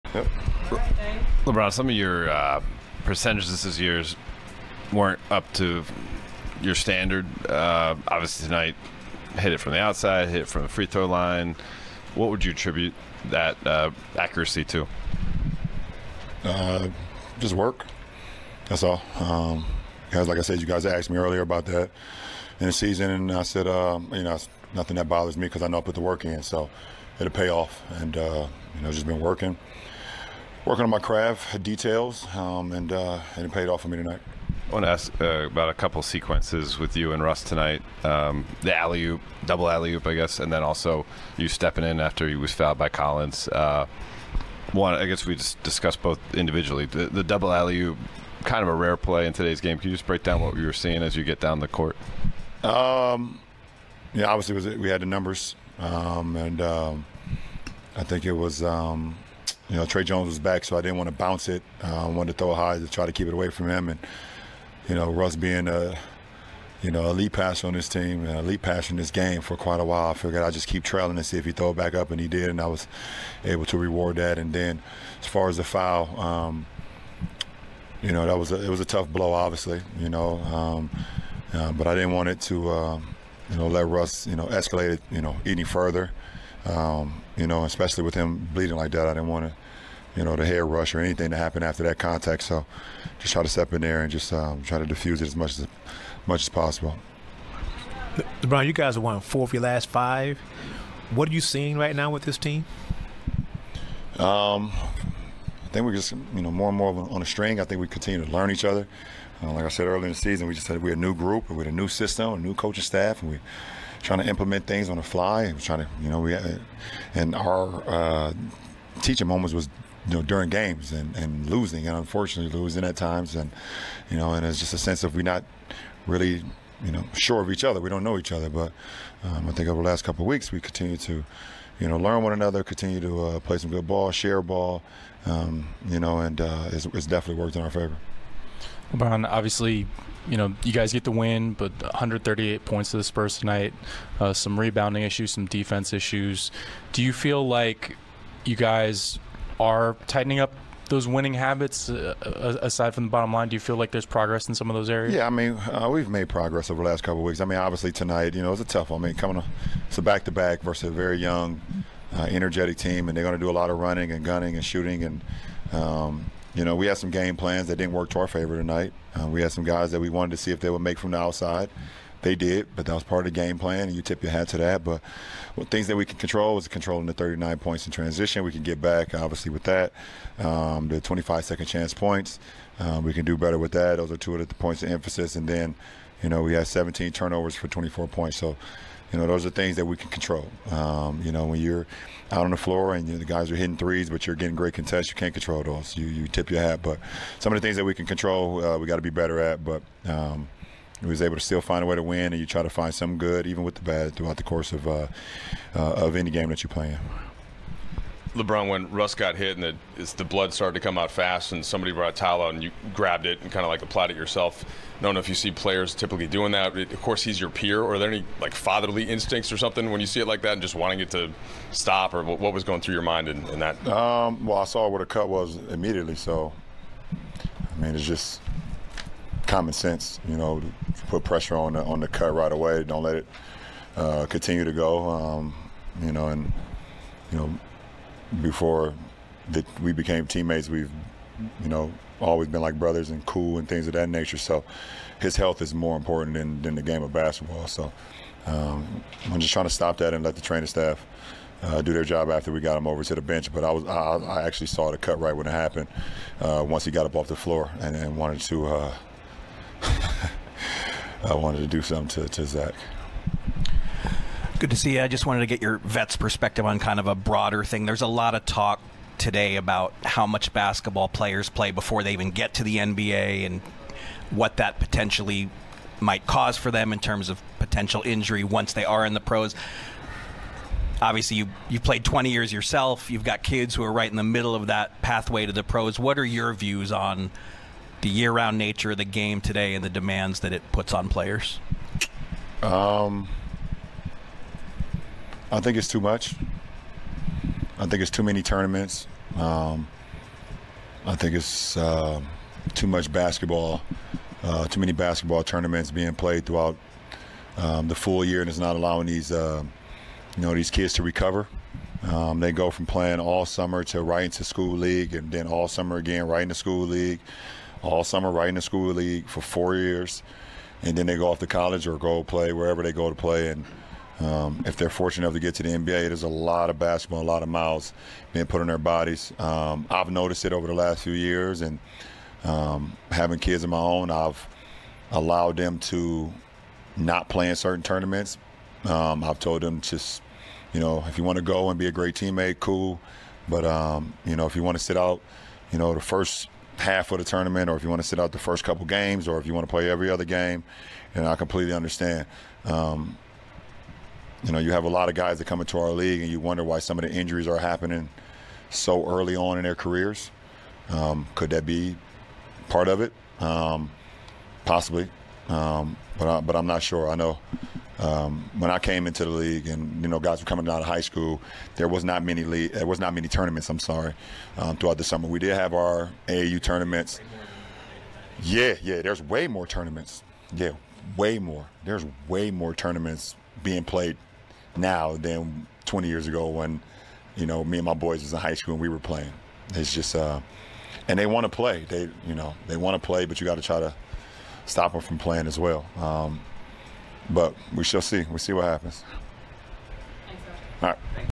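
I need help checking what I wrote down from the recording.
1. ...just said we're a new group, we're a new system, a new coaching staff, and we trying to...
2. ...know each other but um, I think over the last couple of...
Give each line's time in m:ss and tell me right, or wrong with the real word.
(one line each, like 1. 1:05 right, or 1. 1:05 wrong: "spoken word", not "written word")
1. 1:50 right
2. 2:08 right.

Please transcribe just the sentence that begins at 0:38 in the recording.
Um, the alley oop, double alley oop, I guess, and then also you stepping in after he was fouled by Collins.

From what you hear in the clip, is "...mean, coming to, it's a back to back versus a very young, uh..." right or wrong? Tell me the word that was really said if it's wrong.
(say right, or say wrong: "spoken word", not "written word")
right.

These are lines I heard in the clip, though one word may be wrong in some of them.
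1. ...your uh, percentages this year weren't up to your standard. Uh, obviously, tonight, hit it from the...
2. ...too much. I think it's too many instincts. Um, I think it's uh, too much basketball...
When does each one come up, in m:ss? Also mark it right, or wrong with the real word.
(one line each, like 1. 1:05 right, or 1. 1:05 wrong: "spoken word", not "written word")
1. 0:01 right
2. 4:55 wrong: "tournaments", not "instincts".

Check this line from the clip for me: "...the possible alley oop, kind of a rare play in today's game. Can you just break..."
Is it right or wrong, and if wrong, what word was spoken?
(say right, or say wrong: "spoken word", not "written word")
wrong: "double", not "possible".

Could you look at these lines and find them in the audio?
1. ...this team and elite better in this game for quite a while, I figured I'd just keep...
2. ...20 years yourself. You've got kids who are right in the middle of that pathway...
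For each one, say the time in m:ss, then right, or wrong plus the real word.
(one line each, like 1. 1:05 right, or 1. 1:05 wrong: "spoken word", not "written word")
1. 1:07 wrong: "passer", not "better"
2. 4:42 right.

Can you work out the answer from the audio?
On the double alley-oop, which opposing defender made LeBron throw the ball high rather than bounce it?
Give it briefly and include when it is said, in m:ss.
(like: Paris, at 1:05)
Tre Jones, at 0:59.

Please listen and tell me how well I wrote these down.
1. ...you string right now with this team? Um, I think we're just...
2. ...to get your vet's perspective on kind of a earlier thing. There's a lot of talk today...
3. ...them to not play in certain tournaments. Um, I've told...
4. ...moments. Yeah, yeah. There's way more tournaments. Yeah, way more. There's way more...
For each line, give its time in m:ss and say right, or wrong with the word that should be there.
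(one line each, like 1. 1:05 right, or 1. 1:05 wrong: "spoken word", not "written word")
1. 1:41 wrong: "seeing", not "string"
2. 4:25 wrong: "broader", not "earlier"
3. 5:35 right
4. 6:16 wrong: "tournaments", not "moments".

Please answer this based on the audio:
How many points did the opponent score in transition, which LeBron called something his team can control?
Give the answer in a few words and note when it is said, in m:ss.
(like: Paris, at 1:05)
39, at 2:57.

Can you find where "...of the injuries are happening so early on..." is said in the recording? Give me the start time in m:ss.
5:56.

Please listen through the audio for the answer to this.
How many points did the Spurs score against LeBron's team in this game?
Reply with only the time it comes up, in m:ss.
2:21.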